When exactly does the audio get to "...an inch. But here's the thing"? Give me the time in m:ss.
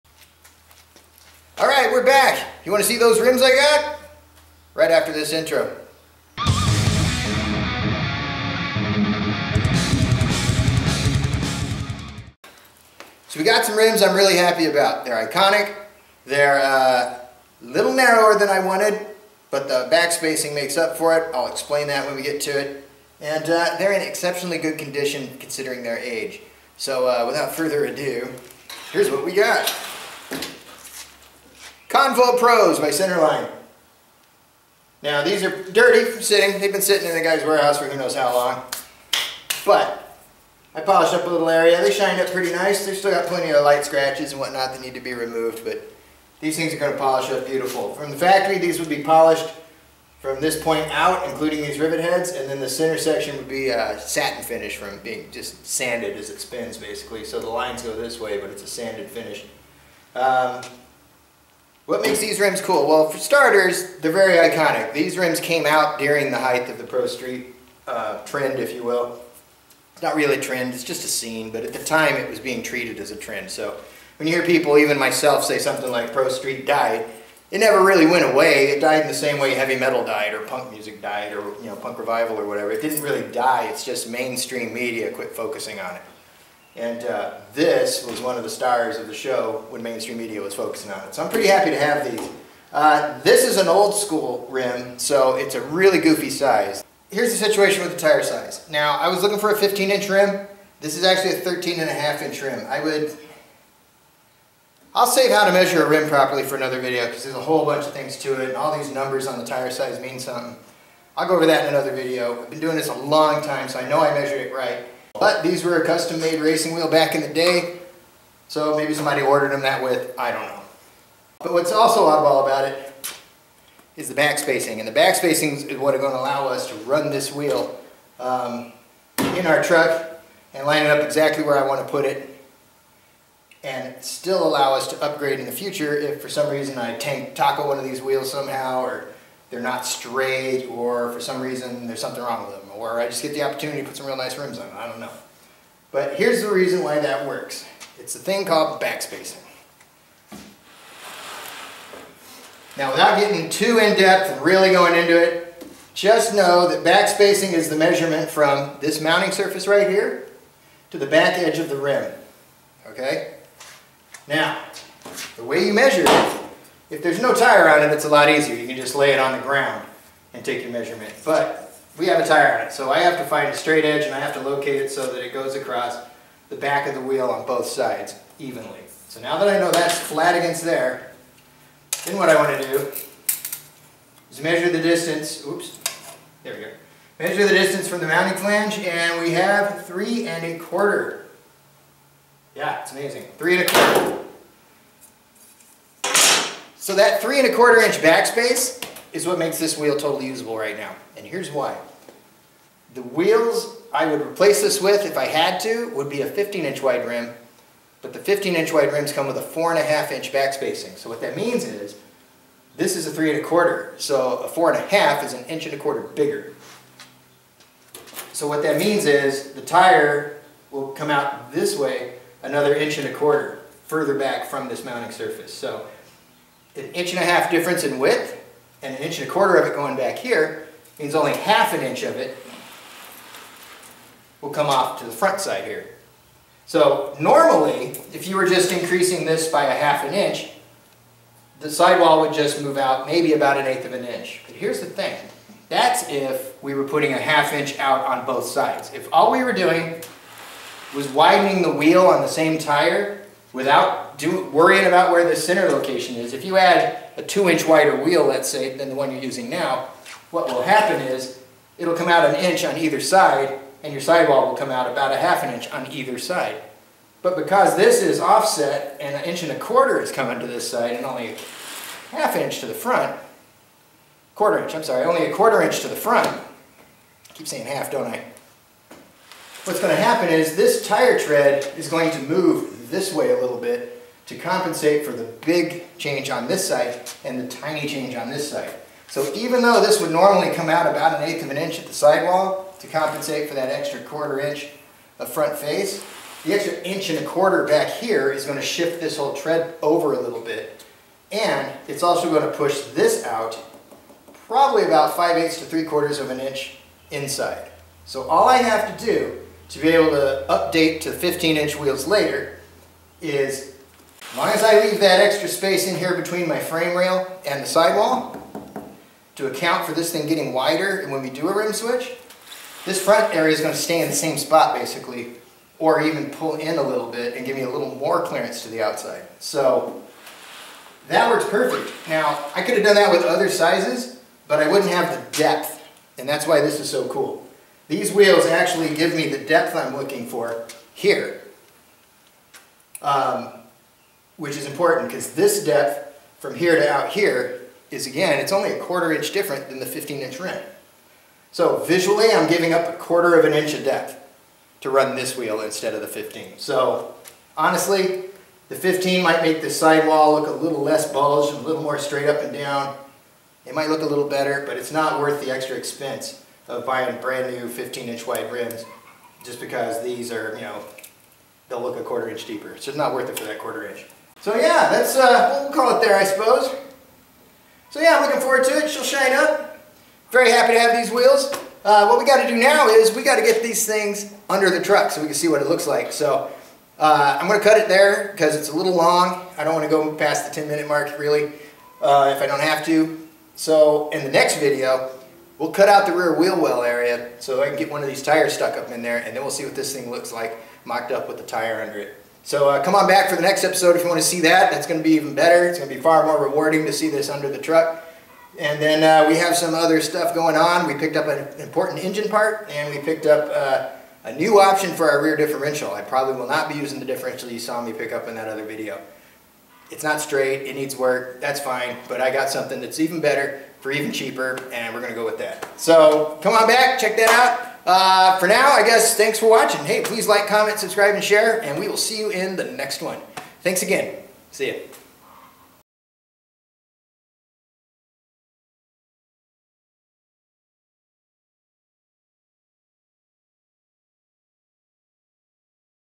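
4:03.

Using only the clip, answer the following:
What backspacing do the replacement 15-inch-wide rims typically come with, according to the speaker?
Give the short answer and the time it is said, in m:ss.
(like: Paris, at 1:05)
4 1/2 inches, at 3:29.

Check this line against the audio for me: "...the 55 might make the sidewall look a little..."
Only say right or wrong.
wrong.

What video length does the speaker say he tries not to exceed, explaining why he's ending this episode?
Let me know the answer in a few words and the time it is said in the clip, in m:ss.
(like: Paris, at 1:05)
10 minutes, at 6:30.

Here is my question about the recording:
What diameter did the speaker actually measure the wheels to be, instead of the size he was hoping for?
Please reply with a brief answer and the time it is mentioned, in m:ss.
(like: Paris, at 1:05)
13.5 inch, at 1:41.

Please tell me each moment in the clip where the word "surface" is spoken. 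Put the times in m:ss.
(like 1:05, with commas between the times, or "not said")
2:39, 3:45.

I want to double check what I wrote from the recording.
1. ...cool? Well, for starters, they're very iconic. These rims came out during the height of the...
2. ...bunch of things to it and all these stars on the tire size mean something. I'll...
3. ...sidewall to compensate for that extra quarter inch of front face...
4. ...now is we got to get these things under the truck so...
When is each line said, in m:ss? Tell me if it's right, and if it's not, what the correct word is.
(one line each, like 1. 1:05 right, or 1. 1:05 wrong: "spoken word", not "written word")
1. 1:02 right
2. 1:47 wrong: "numbers", not "stars"
3. 4:51 right
4. 6:22 right.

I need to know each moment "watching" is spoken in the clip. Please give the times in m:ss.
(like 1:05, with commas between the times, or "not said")
7:09.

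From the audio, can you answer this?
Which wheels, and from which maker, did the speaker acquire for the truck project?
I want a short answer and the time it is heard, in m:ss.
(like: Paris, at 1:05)
Convo Pros by Centerline, at 0:31.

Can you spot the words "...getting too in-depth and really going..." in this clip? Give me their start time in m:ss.
2:33.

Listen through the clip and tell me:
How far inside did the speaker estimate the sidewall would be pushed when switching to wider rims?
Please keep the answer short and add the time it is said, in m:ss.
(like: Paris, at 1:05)
5/8 to 3/4 inch, at 5:05.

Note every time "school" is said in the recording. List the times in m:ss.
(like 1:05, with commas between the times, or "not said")
1:33.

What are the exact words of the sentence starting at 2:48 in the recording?
You can just lay it on the ground and take your measurement.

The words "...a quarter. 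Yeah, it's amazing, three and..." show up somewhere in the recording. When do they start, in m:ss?
3:10.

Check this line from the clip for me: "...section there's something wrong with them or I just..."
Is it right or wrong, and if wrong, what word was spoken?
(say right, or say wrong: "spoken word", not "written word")
wrong: "reason", not "section".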